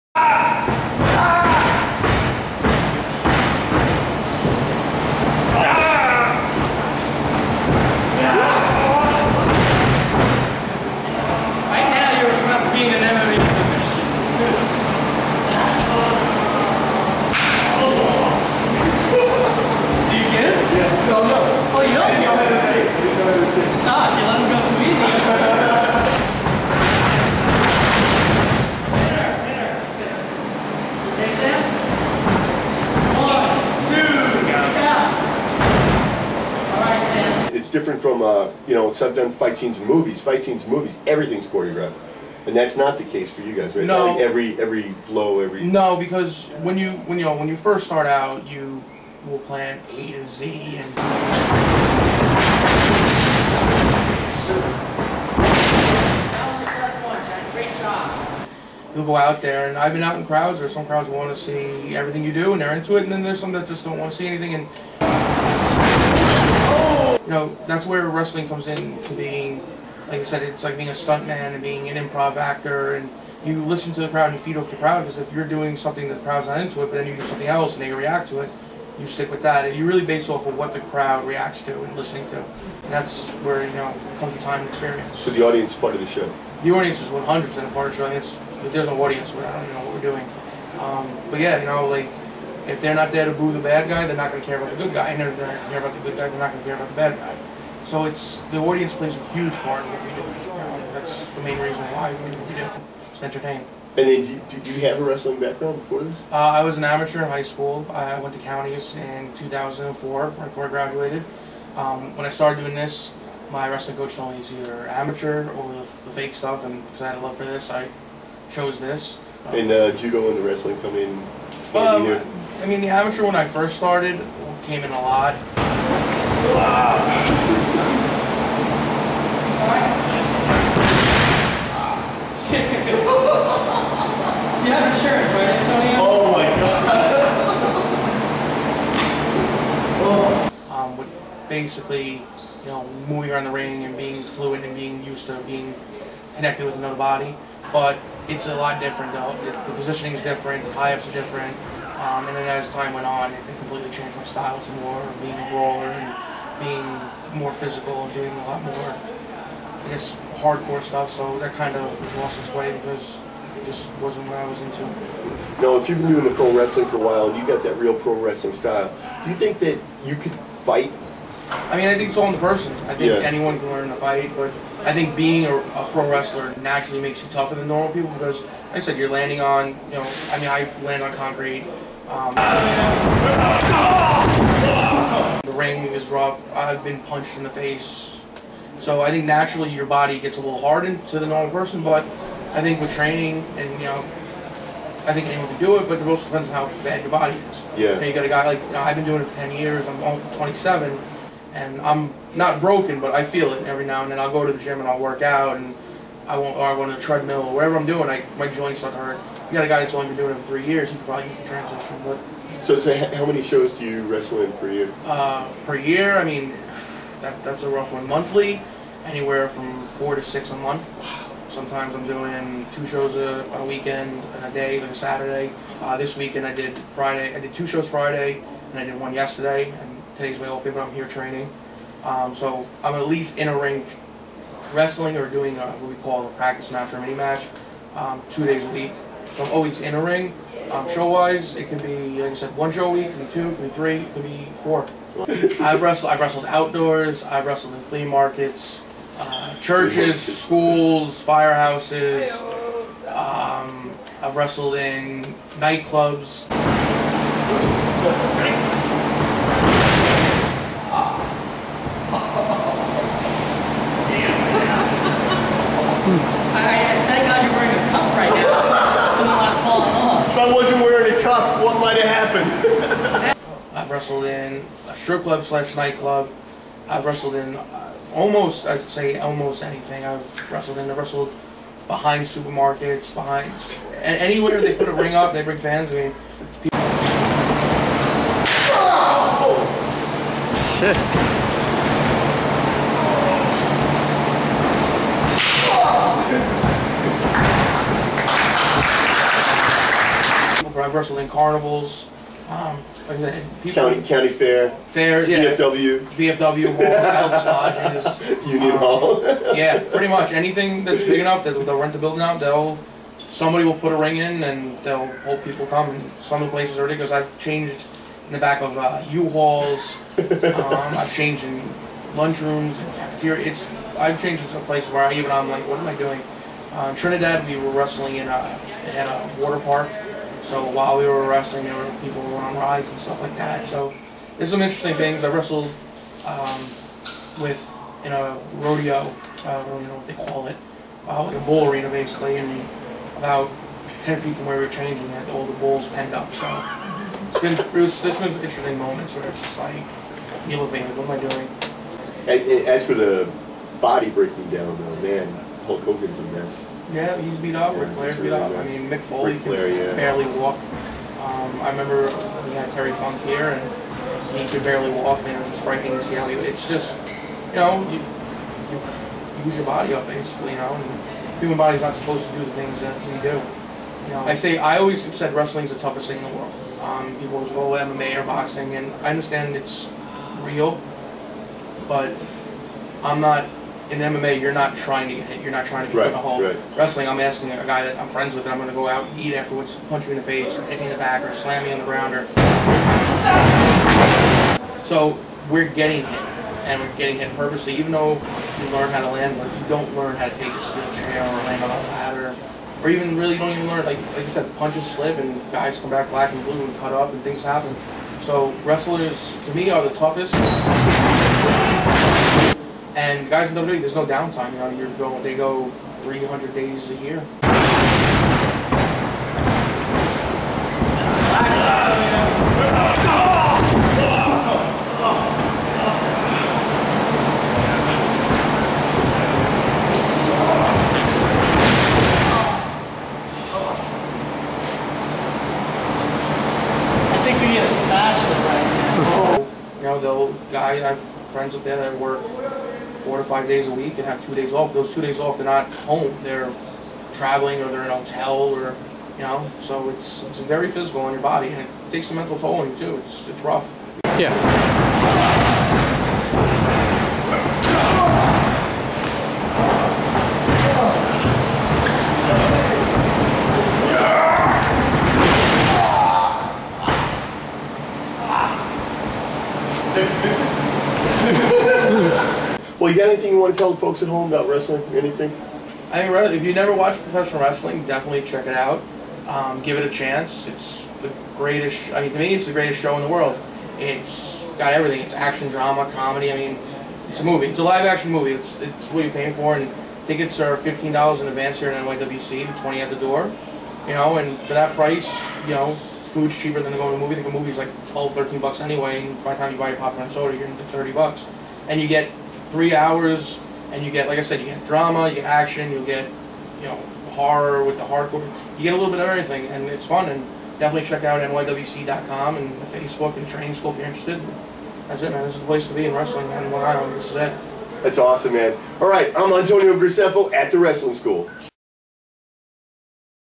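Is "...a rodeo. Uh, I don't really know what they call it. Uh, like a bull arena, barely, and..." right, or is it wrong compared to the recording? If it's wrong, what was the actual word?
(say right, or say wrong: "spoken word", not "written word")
wrong: "basically", not "barely".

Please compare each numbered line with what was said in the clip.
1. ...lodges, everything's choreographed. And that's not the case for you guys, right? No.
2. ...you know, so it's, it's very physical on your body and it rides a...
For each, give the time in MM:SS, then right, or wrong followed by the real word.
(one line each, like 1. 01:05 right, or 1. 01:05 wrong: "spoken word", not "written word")
1. 00:40 wrong: "movies", not "lodges"
2. 07:29 wrong: "takes", not "rides".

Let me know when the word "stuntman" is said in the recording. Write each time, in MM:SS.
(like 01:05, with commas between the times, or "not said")
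01:10.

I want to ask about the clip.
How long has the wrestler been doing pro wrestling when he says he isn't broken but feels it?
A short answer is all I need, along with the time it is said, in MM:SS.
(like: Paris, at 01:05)
10 years, at 03:19.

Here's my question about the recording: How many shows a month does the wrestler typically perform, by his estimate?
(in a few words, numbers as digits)
4 to 6.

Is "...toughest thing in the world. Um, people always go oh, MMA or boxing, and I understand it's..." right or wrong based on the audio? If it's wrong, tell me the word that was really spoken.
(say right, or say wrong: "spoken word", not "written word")
right.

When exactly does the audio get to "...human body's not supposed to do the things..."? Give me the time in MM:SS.
06:11.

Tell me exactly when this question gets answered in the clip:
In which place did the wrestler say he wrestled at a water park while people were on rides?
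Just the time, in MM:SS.
05:26.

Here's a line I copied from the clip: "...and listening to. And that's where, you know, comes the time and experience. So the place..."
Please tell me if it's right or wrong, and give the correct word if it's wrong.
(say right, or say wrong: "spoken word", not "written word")
wrong: "audience", not "place".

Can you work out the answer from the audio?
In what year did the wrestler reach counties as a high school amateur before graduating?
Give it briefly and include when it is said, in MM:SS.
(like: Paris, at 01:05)
2004, at 01:49.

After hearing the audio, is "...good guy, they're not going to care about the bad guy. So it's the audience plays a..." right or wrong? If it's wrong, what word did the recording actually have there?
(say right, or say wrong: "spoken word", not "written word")
right.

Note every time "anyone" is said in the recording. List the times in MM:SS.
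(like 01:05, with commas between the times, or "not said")
02:53, 03:15.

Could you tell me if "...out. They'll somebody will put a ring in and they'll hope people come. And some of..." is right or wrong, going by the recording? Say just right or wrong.
right.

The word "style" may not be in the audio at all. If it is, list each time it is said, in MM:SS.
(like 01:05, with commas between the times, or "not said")
02:34, 02:48.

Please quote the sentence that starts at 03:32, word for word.
But so, so how many shows do you wrestle in per year?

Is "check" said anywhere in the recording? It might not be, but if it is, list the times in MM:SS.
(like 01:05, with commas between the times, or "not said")
07:58, 08:30.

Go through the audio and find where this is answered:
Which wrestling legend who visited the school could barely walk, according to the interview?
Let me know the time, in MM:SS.
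06:02.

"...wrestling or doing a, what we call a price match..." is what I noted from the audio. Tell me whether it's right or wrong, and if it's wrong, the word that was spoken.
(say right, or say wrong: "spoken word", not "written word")
wrong: "practice", not "price".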